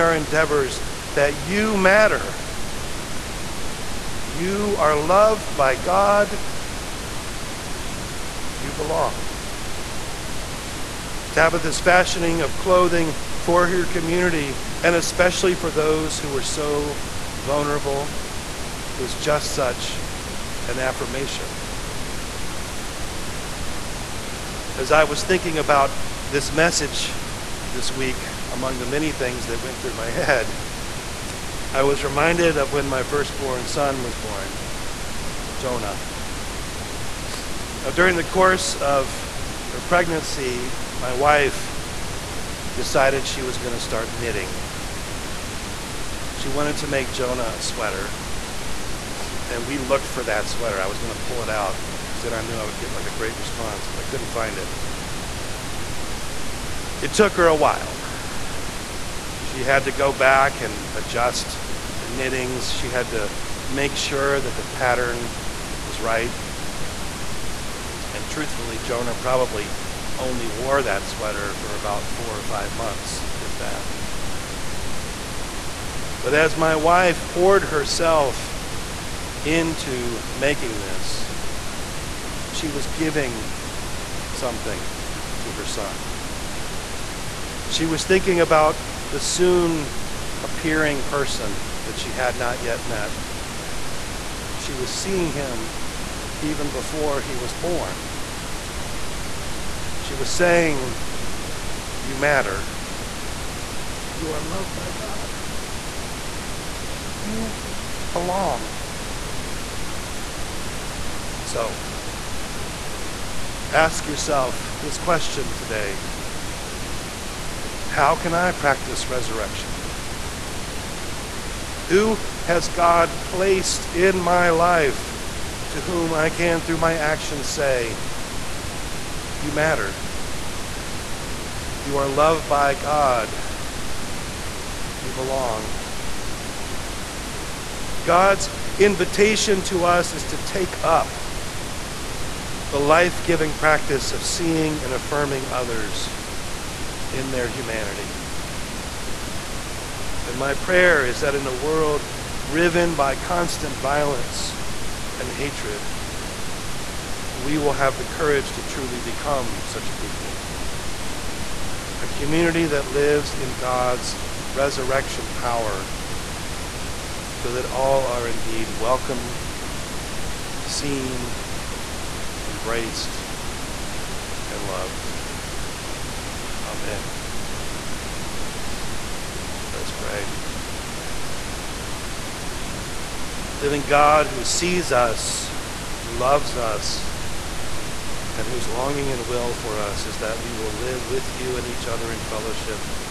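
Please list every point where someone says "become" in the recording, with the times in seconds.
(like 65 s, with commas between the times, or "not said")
158 s.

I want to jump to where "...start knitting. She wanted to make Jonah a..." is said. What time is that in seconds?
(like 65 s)
43 s.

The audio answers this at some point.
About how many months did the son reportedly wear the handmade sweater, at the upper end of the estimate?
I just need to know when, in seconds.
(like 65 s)
72 s.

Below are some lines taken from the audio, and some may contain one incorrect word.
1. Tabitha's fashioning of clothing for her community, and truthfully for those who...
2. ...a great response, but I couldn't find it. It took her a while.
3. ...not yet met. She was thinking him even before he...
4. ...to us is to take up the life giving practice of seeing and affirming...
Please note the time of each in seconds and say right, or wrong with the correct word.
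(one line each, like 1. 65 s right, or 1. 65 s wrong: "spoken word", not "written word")
1. 11 s wrong: "especially", not "truthfully"
2. 53 s right
3. 92 s wrong: "seeing", not "thinking"
4. 139 s right.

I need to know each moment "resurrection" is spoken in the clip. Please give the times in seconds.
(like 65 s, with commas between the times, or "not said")
119 s, 164 s.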